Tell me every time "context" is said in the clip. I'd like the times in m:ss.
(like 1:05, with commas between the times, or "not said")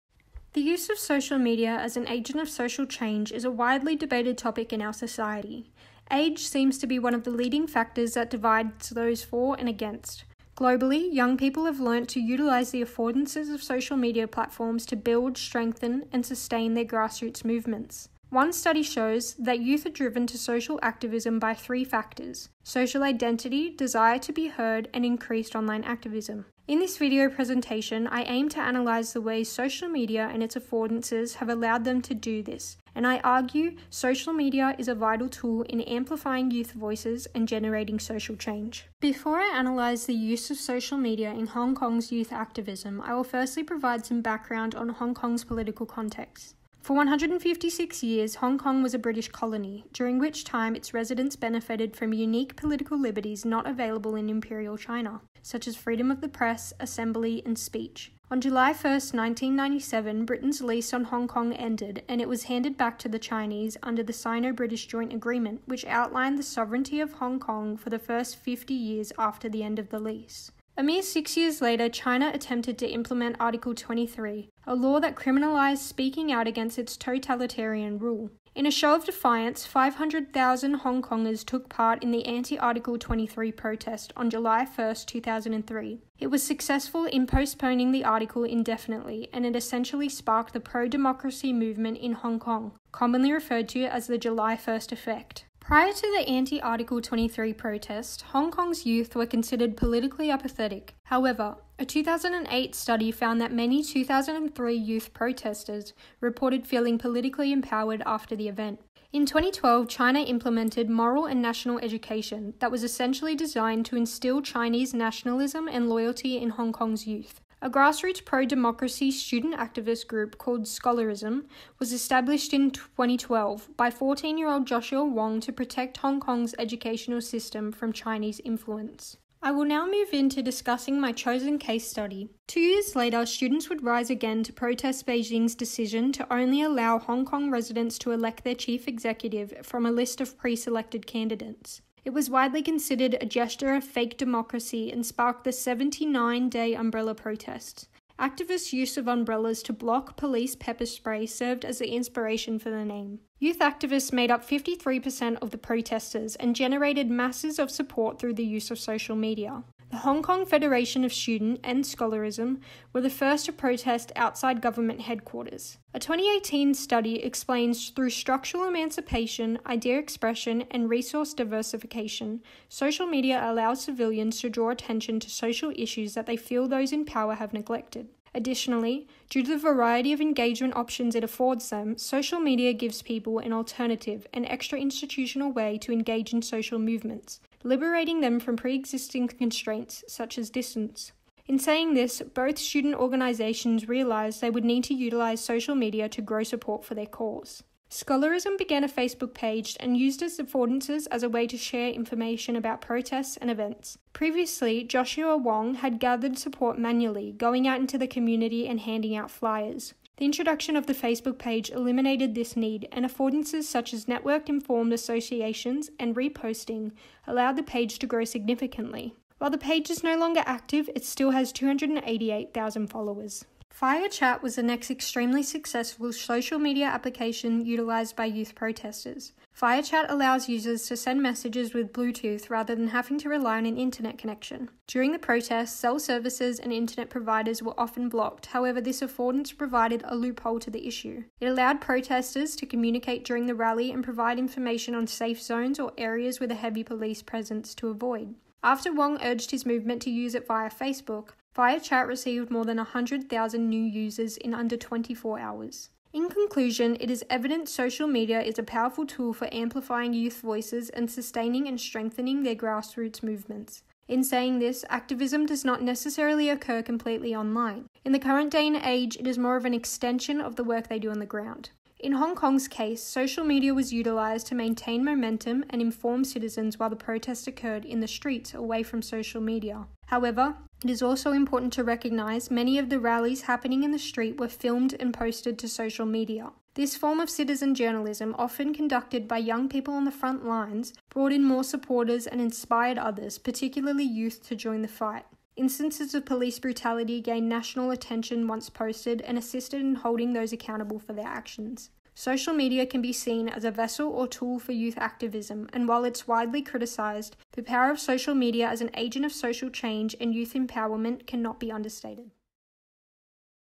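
0:45.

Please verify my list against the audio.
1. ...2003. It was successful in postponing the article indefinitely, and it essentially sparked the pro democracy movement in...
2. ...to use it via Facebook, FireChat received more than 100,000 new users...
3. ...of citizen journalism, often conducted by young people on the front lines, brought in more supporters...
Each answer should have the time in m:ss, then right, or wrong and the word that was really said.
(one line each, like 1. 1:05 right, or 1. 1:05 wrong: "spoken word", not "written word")
1. 1:25 right
2. 4:10 right
3. 4:47 right.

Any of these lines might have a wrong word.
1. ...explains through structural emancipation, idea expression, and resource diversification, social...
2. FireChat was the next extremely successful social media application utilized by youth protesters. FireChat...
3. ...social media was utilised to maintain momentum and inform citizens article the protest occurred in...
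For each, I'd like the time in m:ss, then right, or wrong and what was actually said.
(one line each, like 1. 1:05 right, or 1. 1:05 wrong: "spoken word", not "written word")
1. 2:47 right
2. 3:43 right
3. 4:33 wrong: "while", not "article".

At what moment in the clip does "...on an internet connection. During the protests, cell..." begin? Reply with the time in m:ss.
3:53.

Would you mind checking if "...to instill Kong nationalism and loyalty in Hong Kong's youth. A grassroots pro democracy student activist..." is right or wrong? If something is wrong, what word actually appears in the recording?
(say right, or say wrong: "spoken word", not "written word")
wrong: "Chinese", not "Kong".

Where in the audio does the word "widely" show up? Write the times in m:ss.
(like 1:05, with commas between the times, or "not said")
0:03, 2:22, 5:06.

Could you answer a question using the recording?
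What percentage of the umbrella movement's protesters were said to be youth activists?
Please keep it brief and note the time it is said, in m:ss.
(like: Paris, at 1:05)
53%, at 2:34.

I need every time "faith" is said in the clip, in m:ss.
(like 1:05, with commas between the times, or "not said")
not said.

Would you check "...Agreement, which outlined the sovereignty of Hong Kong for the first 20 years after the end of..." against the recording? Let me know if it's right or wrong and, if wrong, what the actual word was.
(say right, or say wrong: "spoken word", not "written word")
wrong: "50", not "20".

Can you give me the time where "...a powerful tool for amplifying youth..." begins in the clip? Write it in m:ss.
4:18.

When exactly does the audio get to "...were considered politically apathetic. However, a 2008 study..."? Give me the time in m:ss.
1:39.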